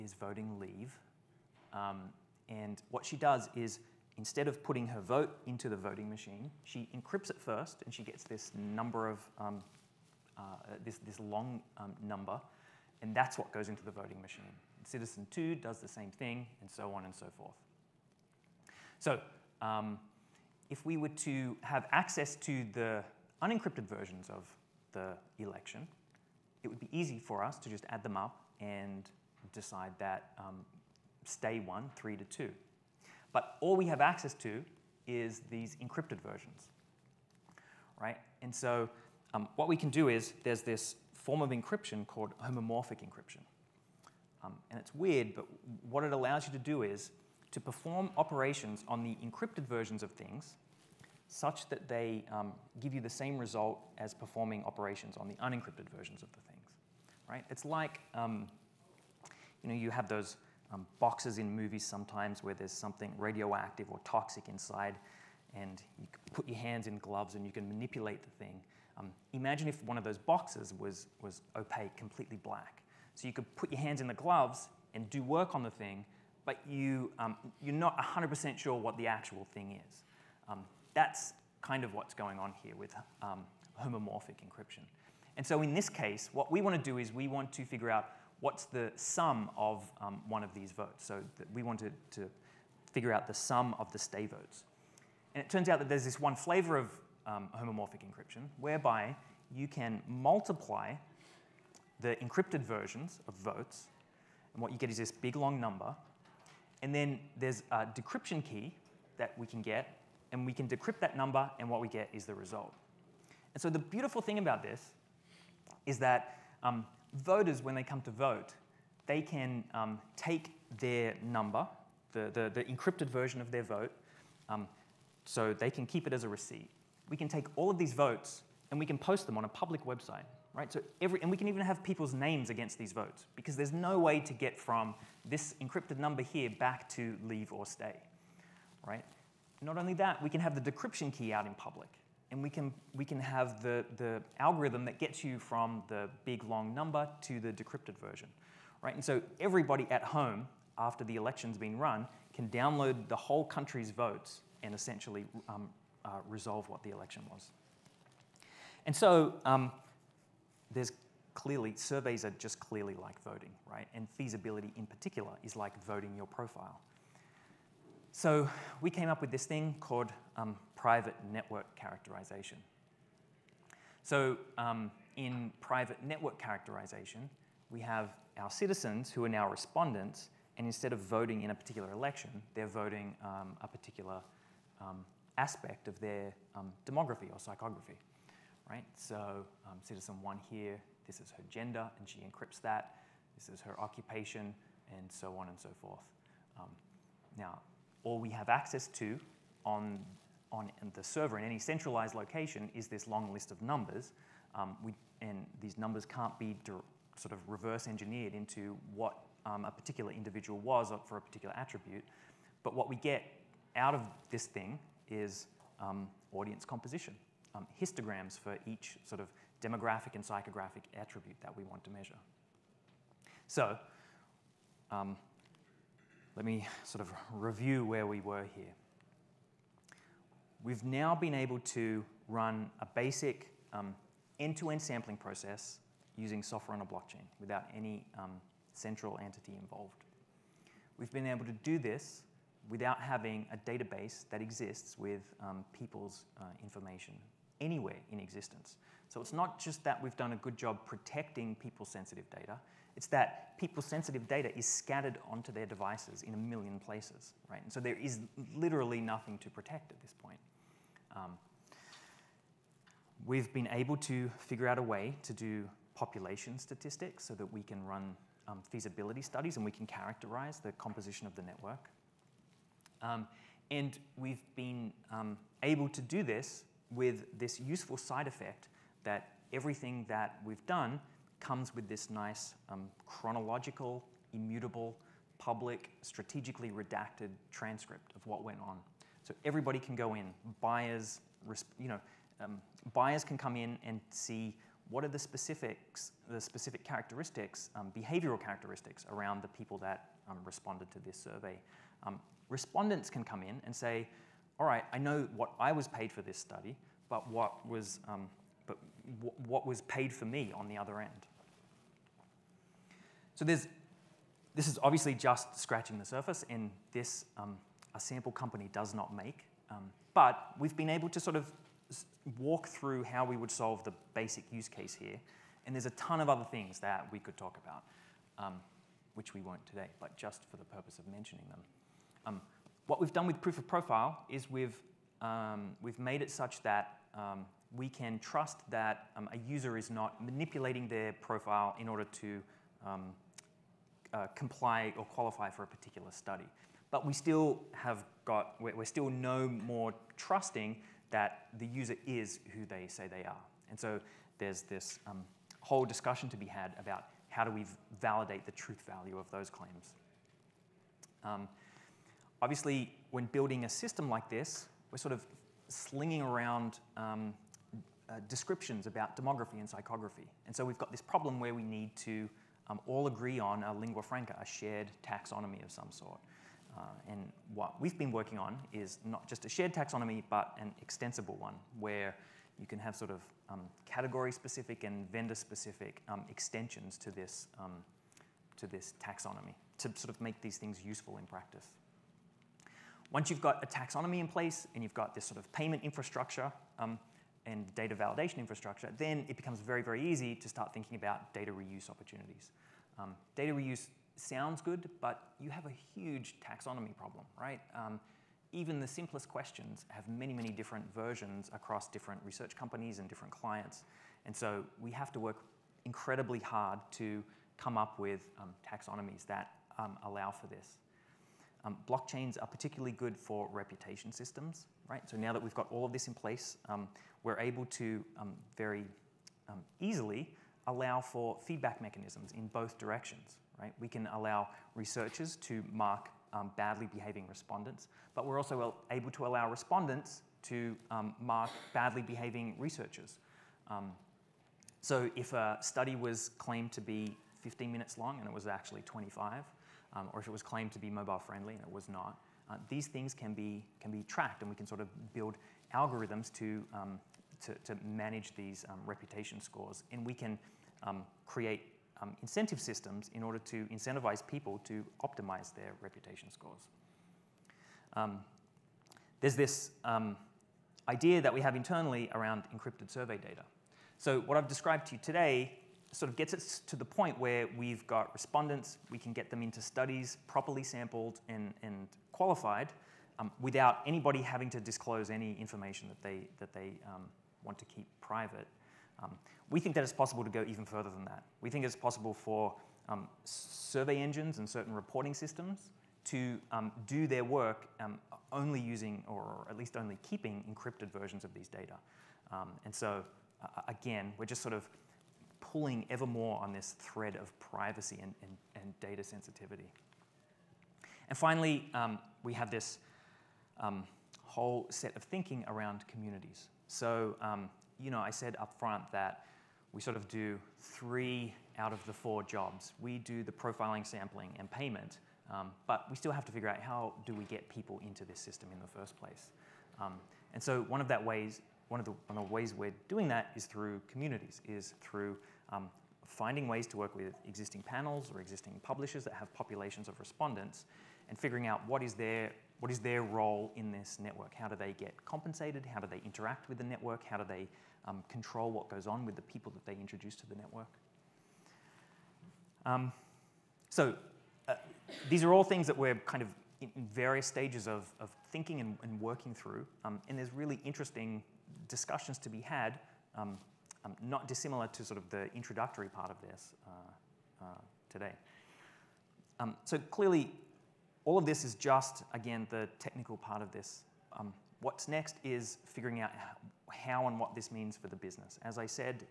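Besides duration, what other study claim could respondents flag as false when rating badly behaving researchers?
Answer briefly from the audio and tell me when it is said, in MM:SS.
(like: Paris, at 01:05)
Mobile friendly, at 07:30.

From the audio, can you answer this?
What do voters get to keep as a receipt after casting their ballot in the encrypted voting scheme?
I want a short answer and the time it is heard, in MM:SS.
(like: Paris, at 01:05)
Encrypted version of their vote, at 02:02.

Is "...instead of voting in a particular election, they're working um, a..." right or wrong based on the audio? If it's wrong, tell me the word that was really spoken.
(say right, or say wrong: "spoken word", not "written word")
wrong: "voting", not "working".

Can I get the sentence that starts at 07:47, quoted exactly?
Um, there's this idea that we have internally around encrypted survey data.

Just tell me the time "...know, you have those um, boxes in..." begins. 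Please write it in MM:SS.
00:59.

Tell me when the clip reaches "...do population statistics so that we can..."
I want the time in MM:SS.
04:25.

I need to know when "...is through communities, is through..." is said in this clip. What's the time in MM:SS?
08:53.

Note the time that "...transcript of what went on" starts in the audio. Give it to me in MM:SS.
04:47.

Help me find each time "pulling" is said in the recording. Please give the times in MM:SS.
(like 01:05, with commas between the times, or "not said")
08:25.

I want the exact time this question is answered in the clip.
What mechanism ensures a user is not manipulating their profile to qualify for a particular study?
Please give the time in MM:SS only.
05:33.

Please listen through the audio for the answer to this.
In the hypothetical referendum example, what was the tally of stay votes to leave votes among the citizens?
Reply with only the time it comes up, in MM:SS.
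00:31.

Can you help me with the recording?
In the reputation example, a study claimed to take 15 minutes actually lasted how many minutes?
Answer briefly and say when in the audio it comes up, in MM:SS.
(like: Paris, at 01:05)
25, at 07:28.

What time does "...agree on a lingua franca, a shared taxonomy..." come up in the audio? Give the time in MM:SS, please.
06:13.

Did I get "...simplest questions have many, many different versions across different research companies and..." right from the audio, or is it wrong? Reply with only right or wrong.
right.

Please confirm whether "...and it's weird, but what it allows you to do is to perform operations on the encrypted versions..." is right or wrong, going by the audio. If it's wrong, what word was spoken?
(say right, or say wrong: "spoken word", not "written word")
right.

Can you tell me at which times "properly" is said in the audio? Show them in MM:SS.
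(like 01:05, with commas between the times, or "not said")
08:00.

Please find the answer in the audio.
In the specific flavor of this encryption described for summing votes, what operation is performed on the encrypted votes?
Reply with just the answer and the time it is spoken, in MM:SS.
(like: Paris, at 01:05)
Multiply, at 01:40.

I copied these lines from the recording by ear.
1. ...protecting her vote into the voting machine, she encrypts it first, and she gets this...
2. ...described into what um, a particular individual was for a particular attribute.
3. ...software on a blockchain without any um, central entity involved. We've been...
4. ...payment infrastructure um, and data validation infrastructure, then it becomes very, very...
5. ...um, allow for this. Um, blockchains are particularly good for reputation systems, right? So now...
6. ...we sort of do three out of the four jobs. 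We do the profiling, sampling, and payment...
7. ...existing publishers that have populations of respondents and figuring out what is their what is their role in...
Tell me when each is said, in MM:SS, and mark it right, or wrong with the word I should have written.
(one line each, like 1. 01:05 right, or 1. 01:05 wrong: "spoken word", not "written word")
1. 00:04 wrong: "putting", not "protecting"
2. 03:27 wrong: "engineered", not "described"
3. 03:56 right
4. 06:35 right
5. 06:59 right
6. 08:39 right
7. 08:58 right.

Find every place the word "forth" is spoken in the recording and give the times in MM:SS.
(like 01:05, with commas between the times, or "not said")
00:17, 03:15.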